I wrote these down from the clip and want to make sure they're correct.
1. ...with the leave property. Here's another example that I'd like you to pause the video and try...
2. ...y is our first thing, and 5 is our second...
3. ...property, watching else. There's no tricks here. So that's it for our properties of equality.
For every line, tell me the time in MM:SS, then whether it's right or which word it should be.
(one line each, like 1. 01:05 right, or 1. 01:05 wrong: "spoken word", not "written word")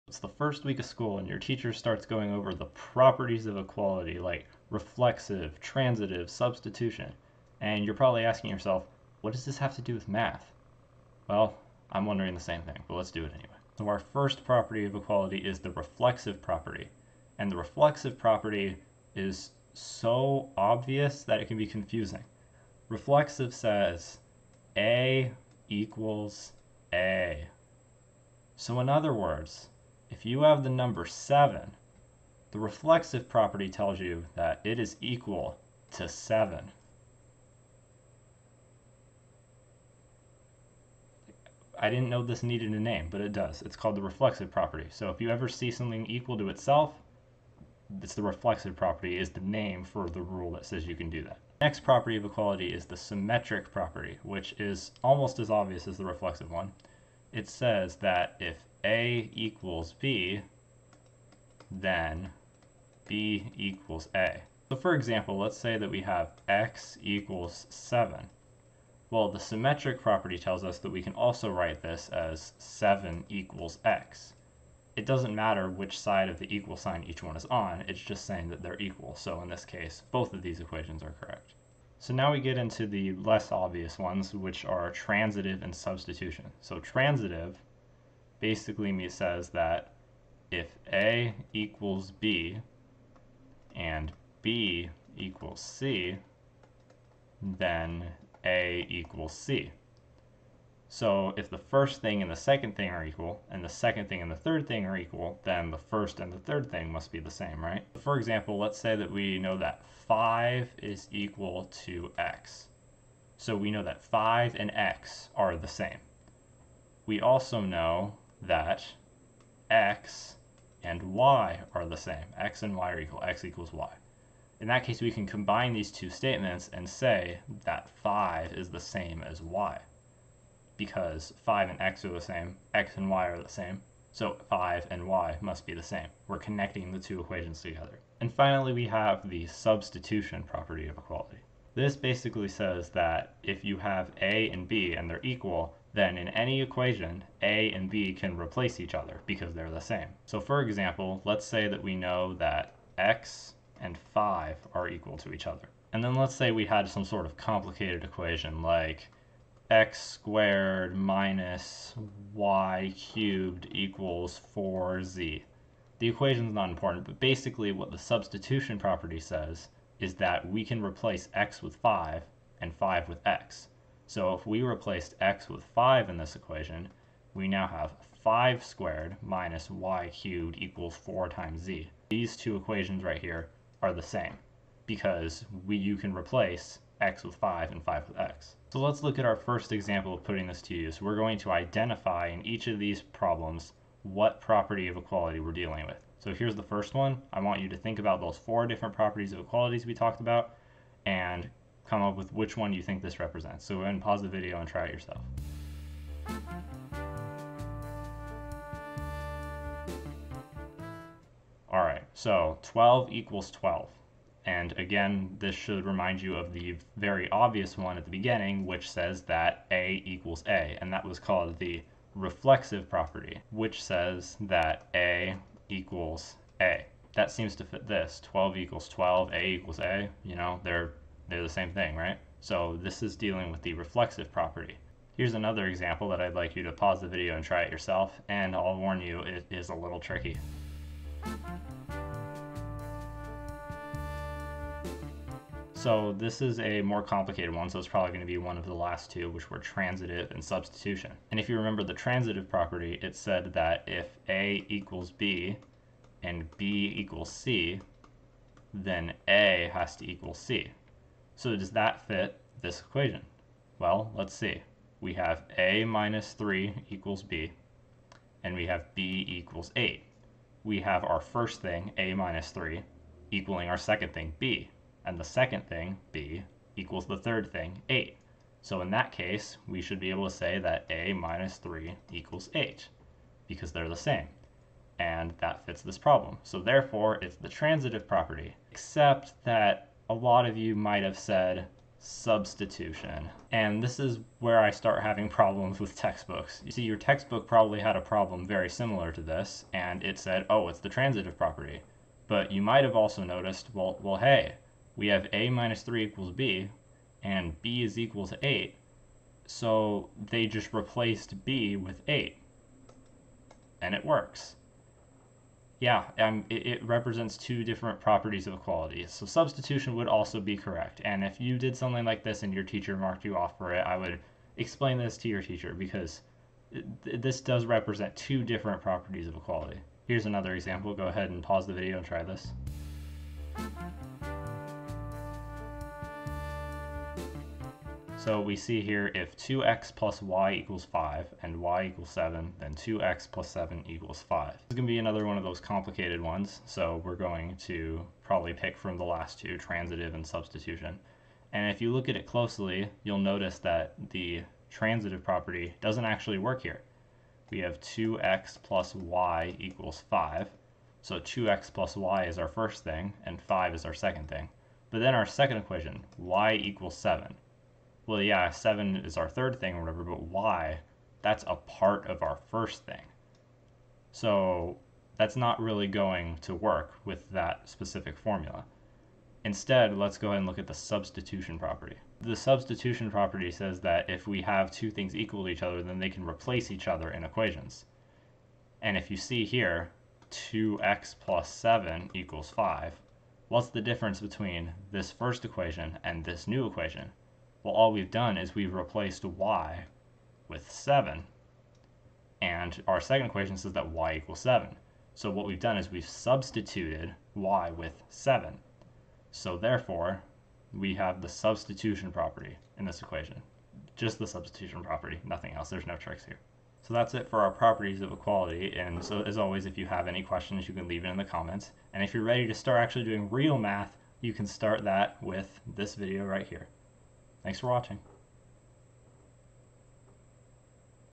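1. 03:53 wrong: "reflexive", not "leave"
2. 06:01 right
3. 06:54 wrong: "nothing", not "watching".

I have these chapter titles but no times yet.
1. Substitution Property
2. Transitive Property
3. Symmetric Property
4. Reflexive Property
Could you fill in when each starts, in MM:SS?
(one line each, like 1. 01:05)
1. 02:18
2. 01:21
3. 00:51
4. 00:13.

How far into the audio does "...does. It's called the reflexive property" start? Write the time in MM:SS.
00:43.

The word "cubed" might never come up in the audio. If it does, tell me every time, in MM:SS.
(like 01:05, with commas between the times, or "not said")
02:42, 03:00.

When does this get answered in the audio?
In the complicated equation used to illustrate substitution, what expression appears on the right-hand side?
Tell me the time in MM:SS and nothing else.
02:44.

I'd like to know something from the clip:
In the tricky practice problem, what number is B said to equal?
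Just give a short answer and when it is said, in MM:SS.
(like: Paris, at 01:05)
8, at 04:28.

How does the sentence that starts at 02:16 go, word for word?
We're connecting the two equations together.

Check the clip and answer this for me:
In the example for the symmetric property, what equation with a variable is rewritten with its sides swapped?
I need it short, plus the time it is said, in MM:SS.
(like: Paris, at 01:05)
X equals 7, at 01:06.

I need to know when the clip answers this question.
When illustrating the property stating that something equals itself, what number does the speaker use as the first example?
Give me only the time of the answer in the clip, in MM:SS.
00:30.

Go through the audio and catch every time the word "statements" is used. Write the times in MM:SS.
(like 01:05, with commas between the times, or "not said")
02:06.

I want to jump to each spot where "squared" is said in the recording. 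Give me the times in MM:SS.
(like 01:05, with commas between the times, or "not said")
02:40, 02:58.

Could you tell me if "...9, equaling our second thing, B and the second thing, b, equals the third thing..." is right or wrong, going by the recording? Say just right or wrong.
wrong.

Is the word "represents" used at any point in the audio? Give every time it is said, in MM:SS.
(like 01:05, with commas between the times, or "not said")
03:23, 05:16, 05:27.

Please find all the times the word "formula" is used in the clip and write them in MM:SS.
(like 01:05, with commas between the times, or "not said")
06:18.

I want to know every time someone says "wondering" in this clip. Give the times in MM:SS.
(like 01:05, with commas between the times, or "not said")
00:12.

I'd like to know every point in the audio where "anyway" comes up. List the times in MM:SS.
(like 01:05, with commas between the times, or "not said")
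00:13.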